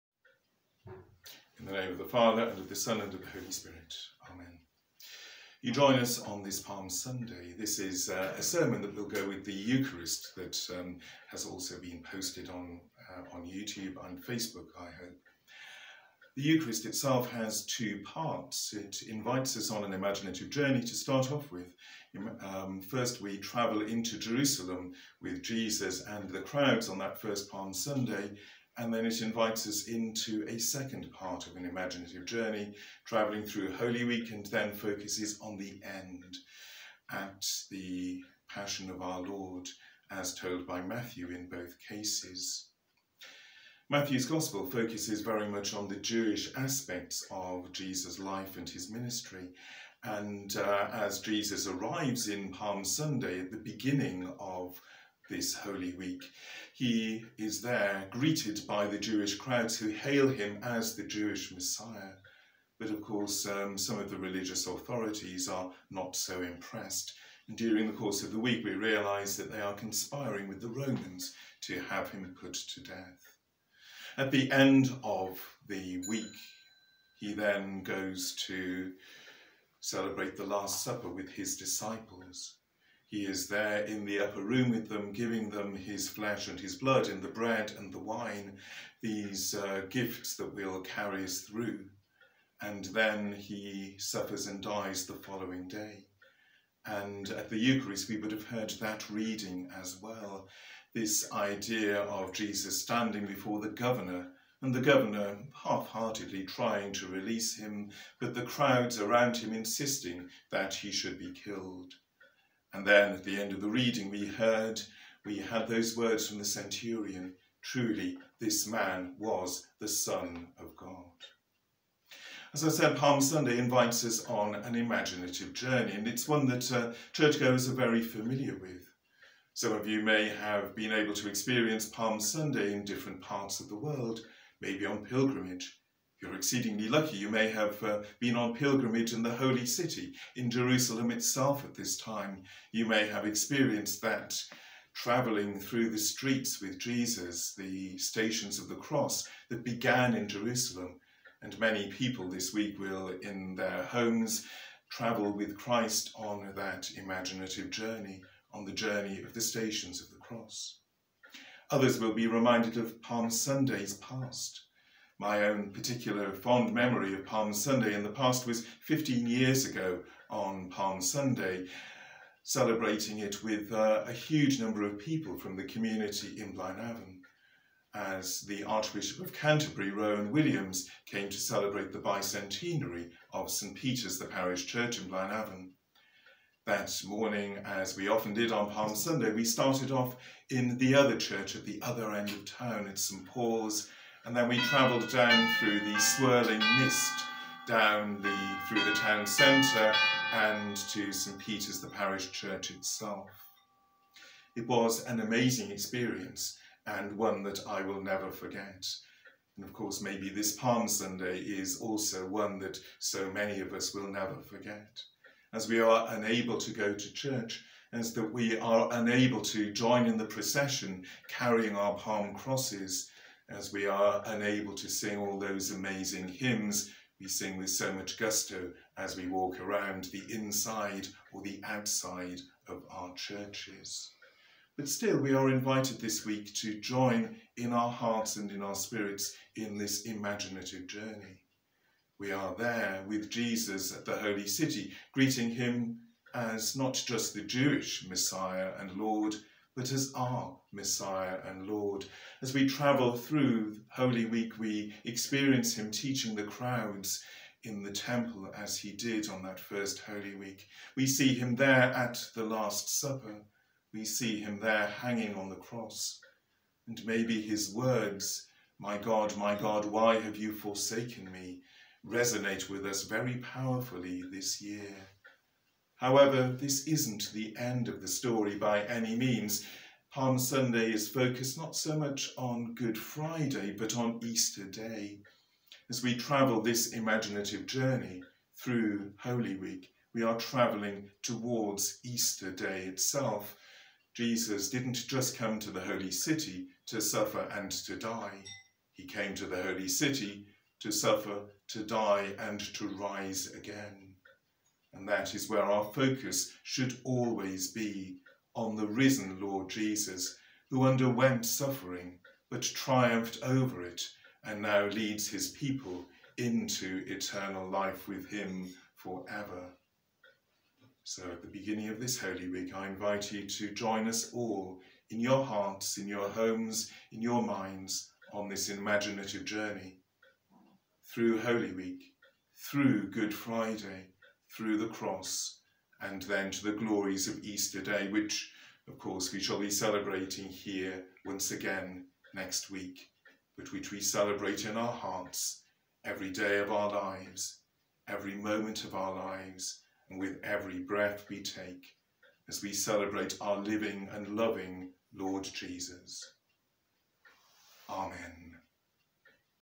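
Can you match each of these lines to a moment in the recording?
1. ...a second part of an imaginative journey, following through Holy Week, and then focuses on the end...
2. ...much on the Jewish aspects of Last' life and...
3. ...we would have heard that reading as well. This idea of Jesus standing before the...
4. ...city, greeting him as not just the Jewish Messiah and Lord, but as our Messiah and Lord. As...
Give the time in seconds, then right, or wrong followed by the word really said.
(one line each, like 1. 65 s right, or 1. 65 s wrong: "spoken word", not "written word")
1. 30 s wrong: "travelling", not "following"
2. 45 s wrong: "Jesus", not "Last"
3. 98 s right
4. 244 s right.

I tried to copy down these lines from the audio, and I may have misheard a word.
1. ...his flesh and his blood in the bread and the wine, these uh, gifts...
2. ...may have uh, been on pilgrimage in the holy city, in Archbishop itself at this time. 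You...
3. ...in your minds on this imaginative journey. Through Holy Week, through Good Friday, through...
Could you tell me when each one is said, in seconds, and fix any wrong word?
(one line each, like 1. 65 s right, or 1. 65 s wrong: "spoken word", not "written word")
1. 85 s right
2. 137 s wrong: "Jerusalem", not "Archbishop"
3. 327 s right.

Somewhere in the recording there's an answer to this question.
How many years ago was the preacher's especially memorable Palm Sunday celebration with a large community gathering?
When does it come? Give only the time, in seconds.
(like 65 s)
168 s.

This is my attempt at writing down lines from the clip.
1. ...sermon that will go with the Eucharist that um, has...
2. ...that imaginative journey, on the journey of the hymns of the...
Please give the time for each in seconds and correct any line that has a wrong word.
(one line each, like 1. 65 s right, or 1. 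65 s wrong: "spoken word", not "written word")
1. 8 s right
2. 156 s wrong: "stations", not "hymns".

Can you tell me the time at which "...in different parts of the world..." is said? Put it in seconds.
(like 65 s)
132 s.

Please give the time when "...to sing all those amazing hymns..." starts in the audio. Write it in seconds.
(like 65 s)
224 s.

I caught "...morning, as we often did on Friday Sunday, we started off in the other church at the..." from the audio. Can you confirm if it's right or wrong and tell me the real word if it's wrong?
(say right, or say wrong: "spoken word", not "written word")
wrong: "Palm", not "Friday".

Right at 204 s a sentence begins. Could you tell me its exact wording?
It was an amazing experience and one that I will never forget.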